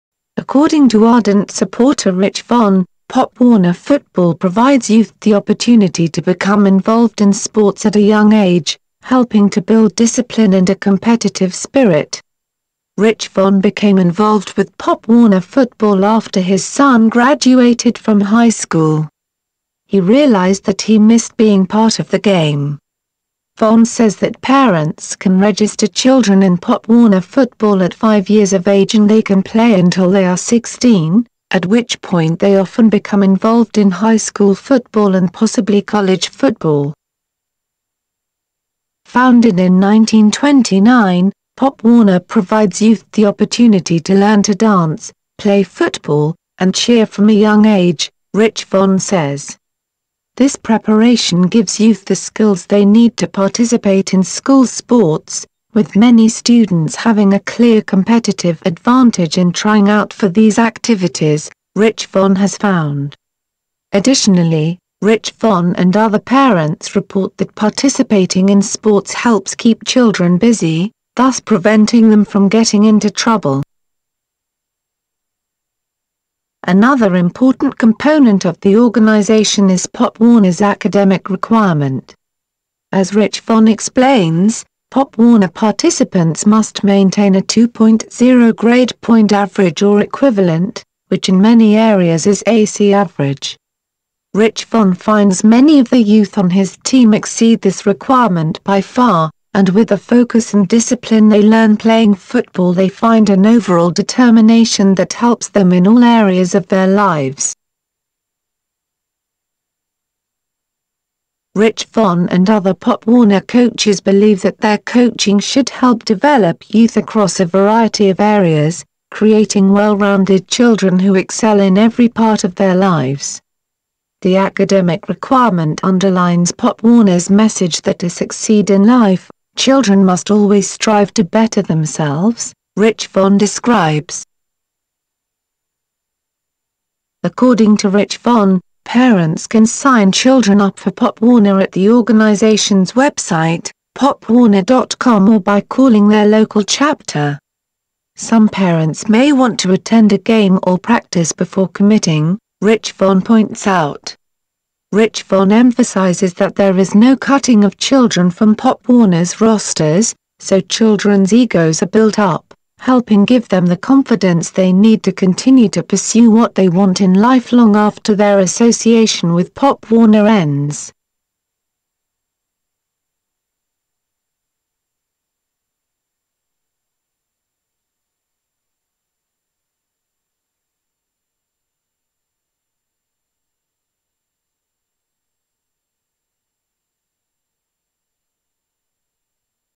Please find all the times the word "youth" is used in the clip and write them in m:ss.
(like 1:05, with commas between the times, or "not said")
0:04, 0:42, 0:51, 1:36, 1:56.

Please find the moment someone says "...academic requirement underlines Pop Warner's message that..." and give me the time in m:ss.
2:04.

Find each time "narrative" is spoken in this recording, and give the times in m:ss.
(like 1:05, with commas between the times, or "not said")
not said.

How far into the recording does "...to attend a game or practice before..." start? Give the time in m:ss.
2:29.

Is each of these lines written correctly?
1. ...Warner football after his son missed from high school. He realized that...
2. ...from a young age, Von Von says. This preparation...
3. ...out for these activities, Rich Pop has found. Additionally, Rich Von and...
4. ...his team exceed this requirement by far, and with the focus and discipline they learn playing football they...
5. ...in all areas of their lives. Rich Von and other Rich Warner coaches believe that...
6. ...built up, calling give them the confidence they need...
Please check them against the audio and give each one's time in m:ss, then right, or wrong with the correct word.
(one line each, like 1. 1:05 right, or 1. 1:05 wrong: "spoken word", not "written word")
1. 0:15 wrong: "graduated", not "missed"
2. 0:47 wrong: "Rich", not "Von"
3. 0:59 wrong: "Von", not "Pop"
4. 1:36 right
5. 1:45 wrong: "Pop", not "Rich"
6. 2:41 wrong: "helping", not "calling".